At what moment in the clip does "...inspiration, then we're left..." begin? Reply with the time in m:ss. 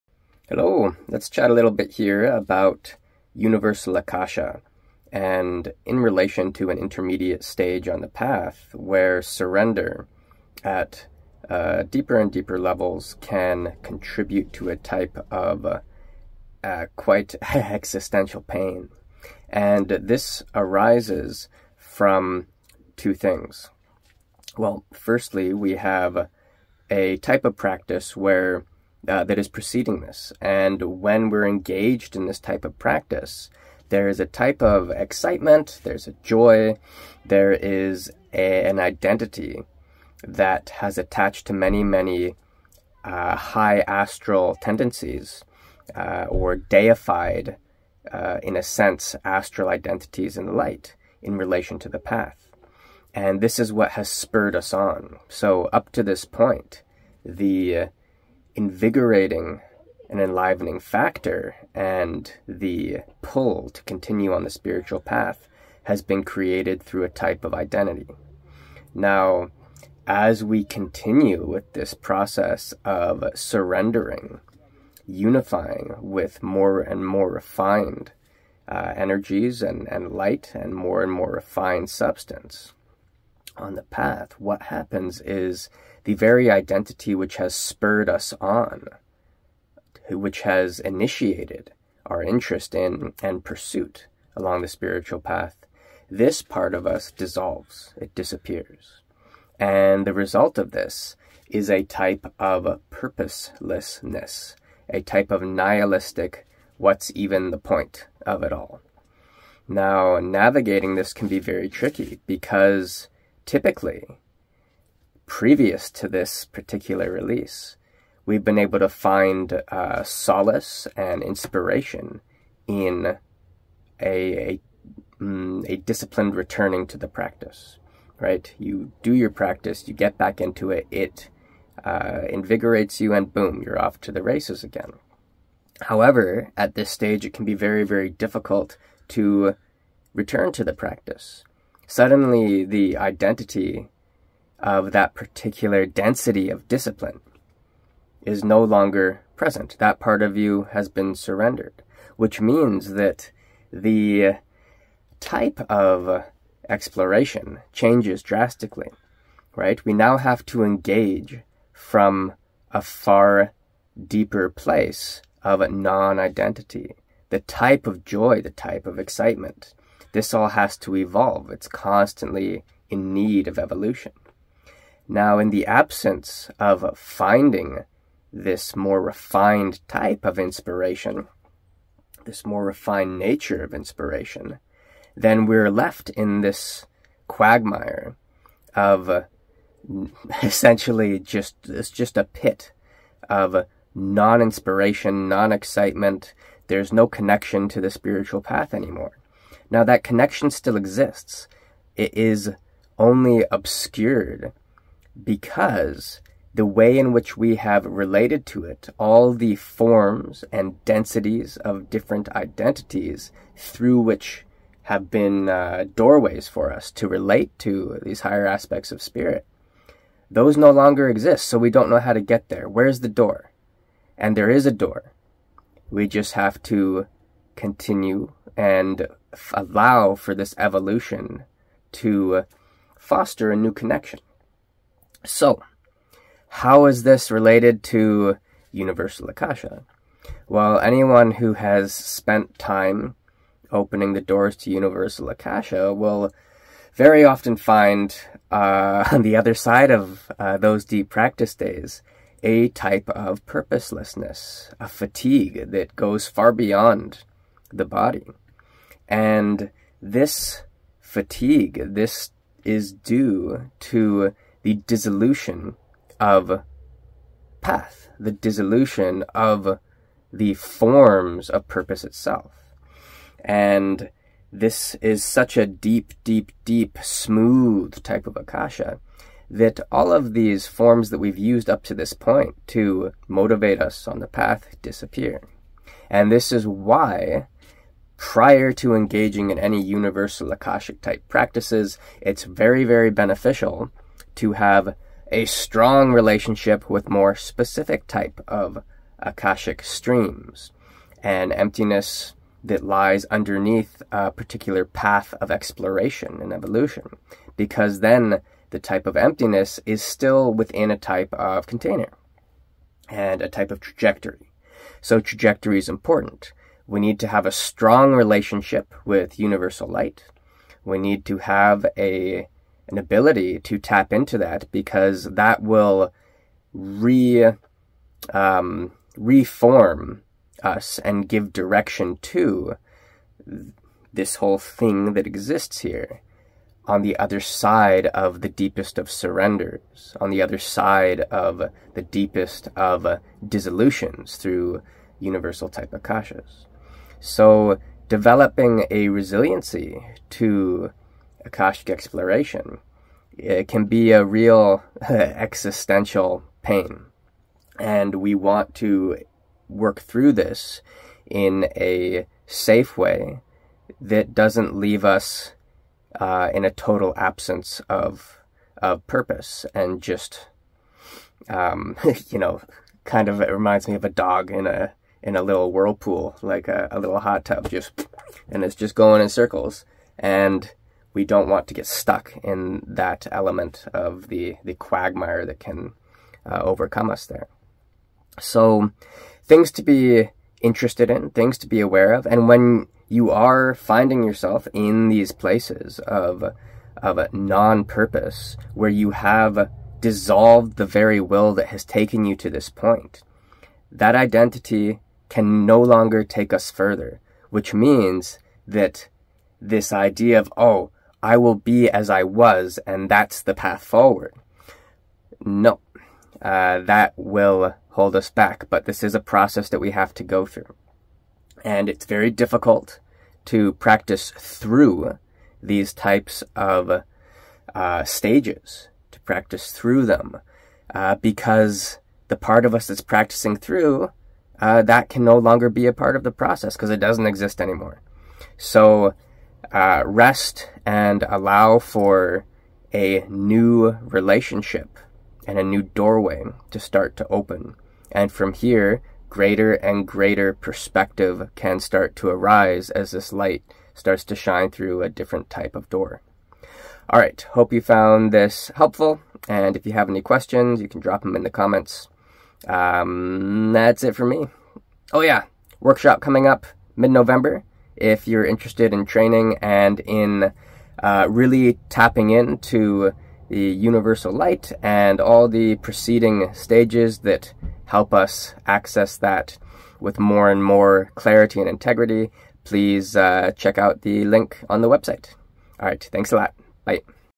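3:03.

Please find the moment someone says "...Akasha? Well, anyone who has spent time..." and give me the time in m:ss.
3:59.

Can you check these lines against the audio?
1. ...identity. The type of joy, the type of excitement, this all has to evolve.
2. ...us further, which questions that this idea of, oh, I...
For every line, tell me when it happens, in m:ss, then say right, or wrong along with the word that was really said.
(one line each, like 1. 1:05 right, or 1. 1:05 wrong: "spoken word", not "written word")
1. 2:46 right
2. 6:46 wrong: "means", not "questions".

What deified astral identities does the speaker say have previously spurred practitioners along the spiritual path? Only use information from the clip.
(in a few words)
High astral tendencies.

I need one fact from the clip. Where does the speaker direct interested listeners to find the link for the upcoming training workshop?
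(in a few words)
The website.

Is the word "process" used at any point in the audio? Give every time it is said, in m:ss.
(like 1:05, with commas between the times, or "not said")
1:11, 6:59, 7:16.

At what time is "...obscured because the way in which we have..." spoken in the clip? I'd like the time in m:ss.
3:23.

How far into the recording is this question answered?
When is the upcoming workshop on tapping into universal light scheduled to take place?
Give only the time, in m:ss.
7:46.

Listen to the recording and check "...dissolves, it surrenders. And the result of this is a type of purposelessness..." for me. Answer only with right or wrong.
wrong.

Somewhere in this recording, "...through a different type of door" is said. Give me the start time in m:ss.
7:34.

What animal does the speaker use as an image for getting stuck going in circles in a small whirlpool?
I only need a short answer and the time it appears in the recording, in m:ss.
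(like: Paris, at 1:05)
A dog, at 6:14.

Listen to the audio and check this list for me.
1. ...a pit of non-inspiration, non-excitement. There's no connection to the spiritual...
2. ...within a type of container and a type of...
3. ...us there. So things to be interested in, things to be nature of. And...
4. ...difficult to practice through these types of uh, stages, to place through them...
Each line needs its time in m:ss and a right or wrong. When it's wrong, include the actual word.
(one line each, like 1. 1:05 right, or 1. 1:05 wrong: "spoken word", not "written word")
1. 3:12 right
2. 5:10 right
3. 6:27 wrong: "aware", not "nature"
4. 7:02 wrong: "practice", not "place".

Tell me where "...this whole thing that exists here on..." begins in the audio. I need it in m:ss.
5:34.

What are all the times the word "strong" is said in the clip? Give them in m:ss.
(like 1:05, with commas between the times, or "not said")
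4:55, 5:17.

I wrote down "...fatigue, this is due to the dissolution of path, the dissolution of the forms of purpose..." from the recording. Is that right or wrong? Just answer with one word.
right.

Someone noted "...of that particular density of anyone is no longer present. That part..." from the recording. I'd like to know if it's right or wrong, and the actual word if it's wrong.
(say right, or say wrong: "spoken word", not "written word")
wrong: "discipline", not "anyone".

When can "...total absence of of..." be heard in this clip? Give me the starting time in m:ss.
6:06.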